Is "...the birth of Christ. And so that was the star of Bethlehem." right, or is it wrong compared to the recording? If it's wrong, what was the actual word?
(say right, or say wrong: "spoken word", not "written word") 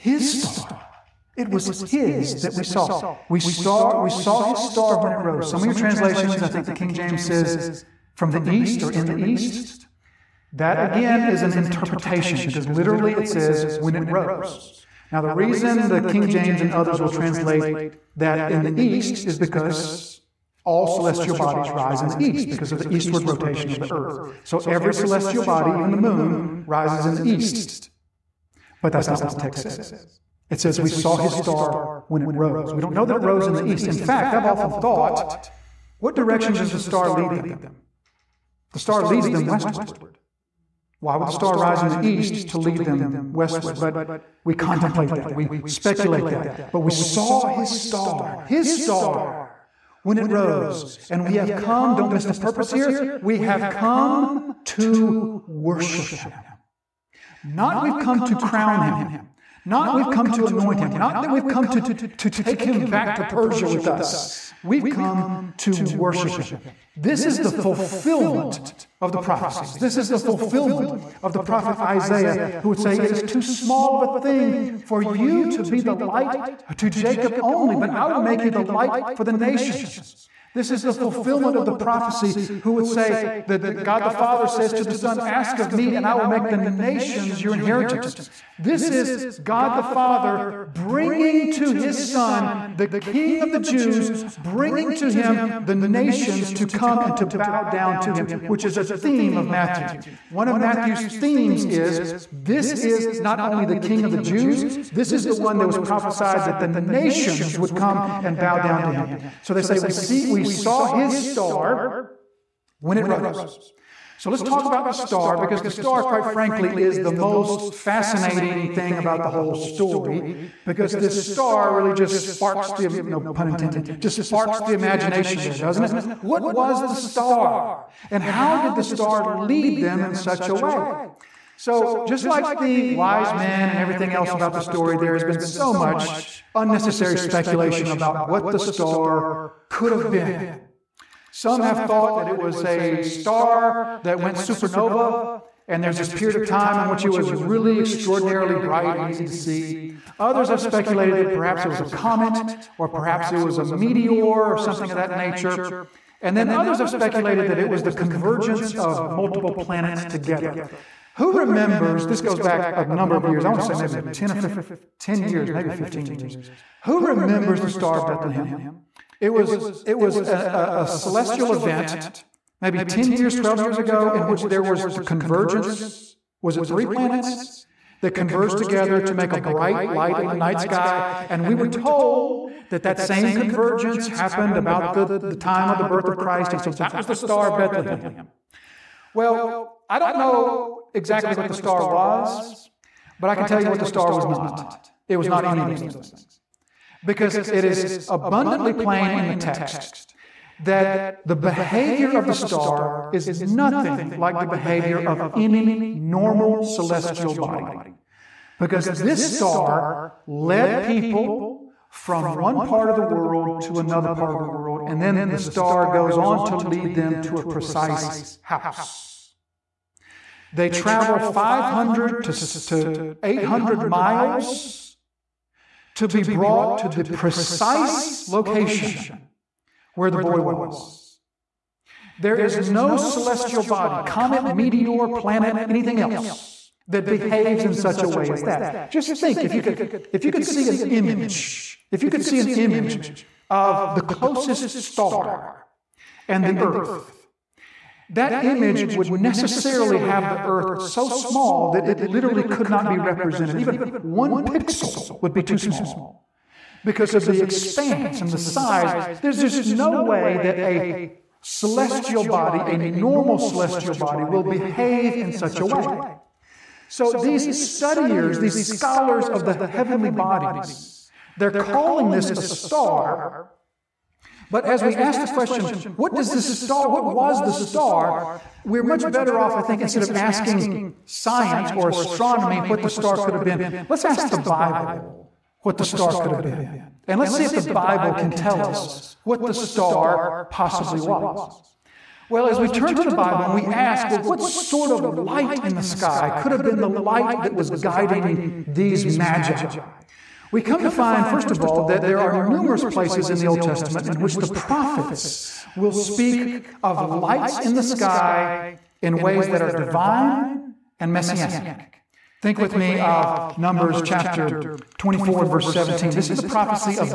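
right.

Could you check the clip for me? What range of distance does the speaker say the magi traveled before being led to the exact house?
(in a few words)
500 to 800 miles.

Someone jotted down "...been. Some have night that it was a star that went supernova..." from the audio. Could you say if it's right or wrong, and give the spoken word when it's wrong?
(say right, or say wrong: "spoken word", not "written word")
wrong: "thought", not "night".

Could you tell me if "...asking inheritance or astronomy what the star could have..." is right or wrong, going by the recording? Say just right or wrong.
wrong.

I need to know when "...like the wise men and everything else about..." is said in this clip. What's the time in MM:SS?
02:12.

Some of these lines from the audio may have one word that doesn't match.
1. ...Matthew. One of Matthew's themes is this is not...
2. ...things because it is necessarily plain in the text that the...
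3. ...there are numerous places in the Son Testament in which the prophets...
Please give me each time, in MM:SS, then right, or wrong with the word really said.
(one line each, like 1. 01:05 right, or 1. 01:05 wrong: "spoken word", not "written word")
1. 01:39 right
2. 03:15 wrong: "abundantly", not "necessarily"
3. 05:02 wrong: "Old", not "Son".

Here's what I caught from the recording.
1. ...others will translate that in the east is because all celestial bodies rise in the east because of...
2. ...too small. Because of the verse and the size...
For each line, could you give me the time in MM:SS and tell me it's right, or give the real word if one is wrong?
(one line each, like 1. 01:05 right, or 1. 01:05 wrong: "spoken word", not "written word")
1. 00:16 right
2. 04:15 wrong: "expanse", not "verse".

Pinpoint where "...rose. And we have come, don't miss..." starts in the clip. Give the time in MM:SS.
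00:50.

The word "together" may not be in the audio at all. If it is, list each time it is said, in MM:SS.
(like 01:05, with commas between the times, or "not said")
02:40, 02:58.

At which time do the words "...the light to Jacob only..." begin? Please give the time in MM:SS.
01:15.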